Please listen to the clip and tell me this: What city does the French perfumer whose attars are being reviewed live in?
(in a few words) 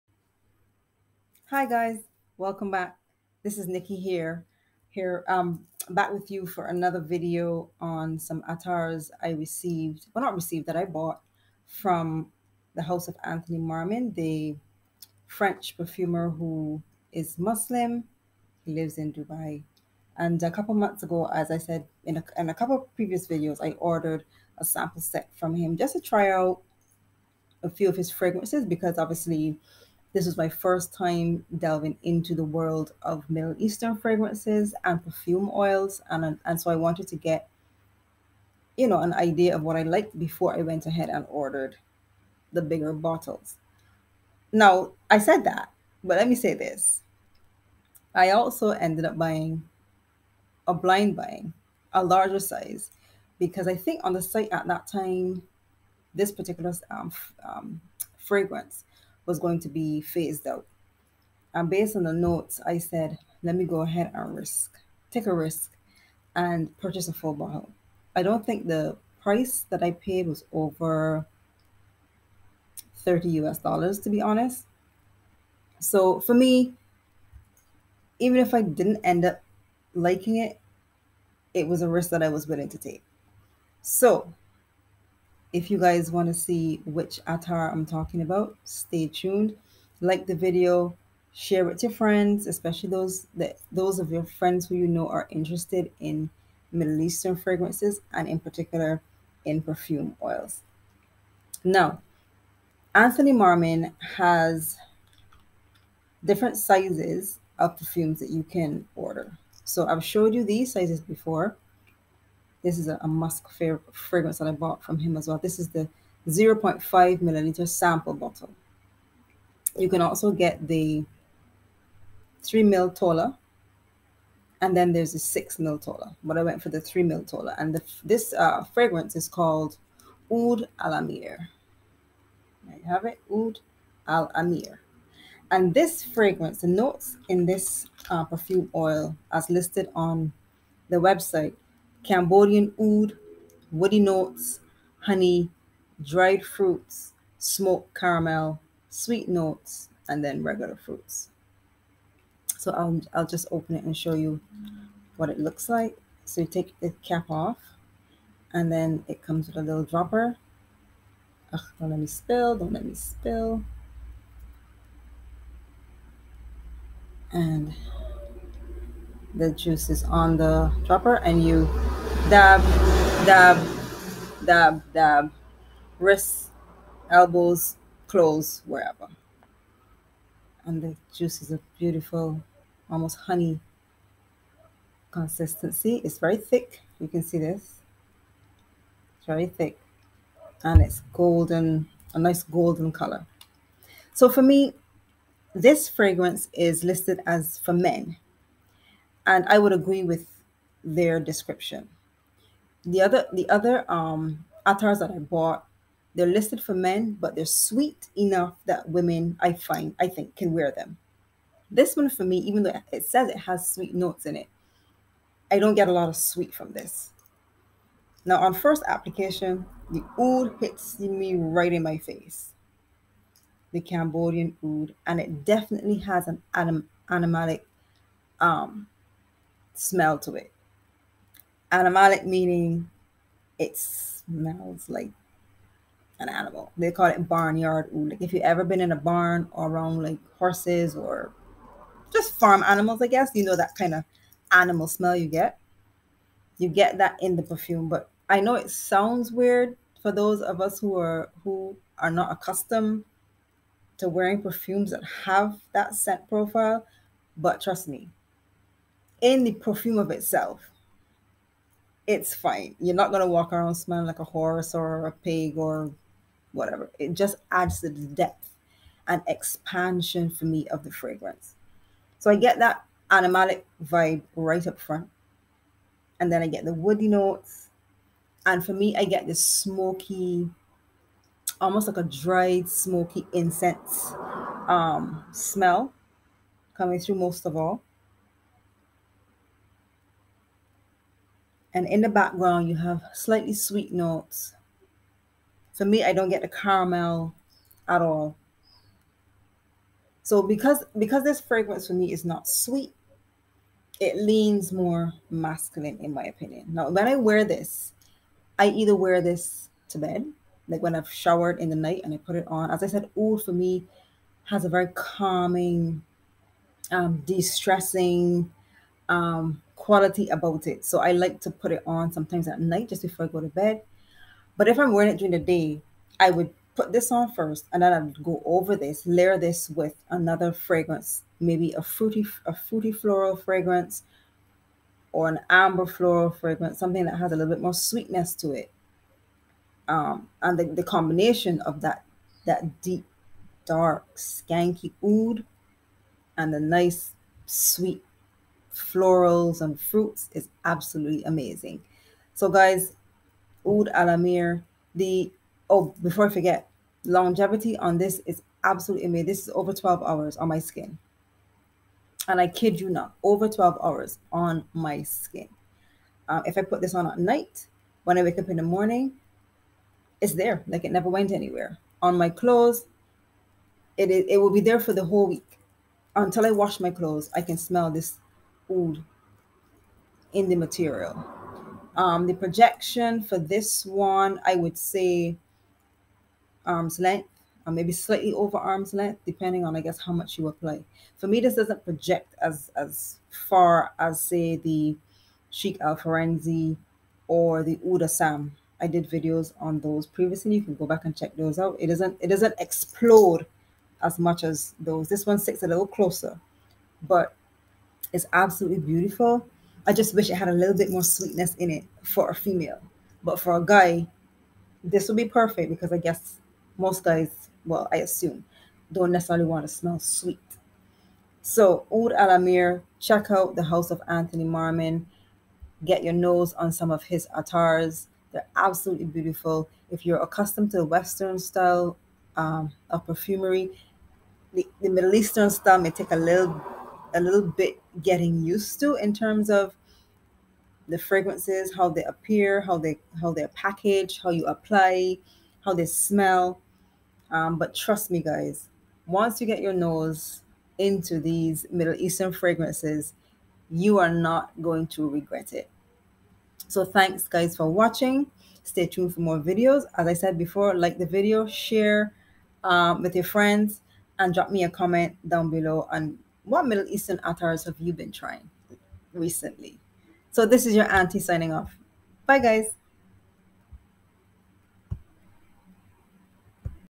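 Dubai.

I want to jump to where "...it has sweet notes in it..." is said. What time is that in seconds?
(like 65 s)
213 s.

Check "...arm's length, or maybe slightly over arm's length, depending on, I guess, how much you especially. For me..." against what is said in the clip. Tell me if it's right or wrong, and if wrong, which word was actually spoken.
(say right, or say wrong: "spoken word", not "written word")
wrong: "apply", not "especially".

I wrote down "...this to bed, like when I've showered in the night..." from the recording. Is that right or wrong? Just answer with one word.
right.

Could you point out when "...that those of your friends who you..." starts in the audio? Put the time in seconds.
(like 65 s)
93 s.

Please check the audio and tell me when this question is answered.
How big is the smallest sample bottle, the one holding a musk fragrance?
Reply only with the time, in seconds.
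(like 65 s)
116 s.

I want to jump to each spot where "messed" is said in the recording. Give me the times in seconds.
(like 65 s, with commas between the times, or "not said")
not said.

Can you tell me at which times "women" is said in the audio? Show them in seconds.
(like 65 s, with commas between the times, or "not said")
208 s.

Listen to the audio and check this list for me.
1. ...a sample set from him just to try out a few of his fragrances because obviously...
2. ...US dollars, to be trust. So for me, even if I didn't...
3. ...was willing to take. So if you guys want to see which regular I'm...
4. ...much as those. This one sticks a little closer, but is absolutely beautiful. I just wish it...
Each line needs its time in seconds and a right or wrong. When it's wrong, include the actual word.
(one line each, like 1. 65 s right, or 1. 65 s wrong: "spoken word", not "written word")
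1. 24 s right
2. 73 s wrong: "honest", not "trust"
3. 82 s wrong: "attar", not "regular"
4. 404 s right.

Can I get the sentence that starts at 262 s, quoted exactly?
You're not going to walk around smelling like a horse or a pig or whatever.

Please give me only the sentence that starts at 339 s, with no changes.
Um, and the, the combination of that that deep, dark, skanky oud and the nice sweet florals and fruits is absolutely amazing.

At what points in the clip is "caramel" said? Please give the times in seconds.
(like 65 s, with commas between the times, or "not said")
147 s, 296 s.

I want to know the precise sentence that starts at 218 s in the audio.
Now on first application, the oud hits me right in my face.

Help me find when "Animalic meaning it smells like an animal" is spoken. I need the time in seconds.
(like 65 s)
231 s.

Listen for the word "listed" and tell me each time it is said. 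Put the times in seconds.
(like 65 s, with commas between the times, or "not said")
139 s, 196 s, 206 s.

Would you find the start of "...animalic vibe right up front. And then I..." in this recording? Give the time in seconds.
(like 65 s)
273 s.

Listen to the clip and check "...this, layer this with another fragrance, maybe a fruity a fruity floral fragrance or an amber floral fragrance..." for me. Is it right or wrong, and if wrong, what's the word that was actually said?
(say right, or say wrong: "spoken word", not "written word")
right.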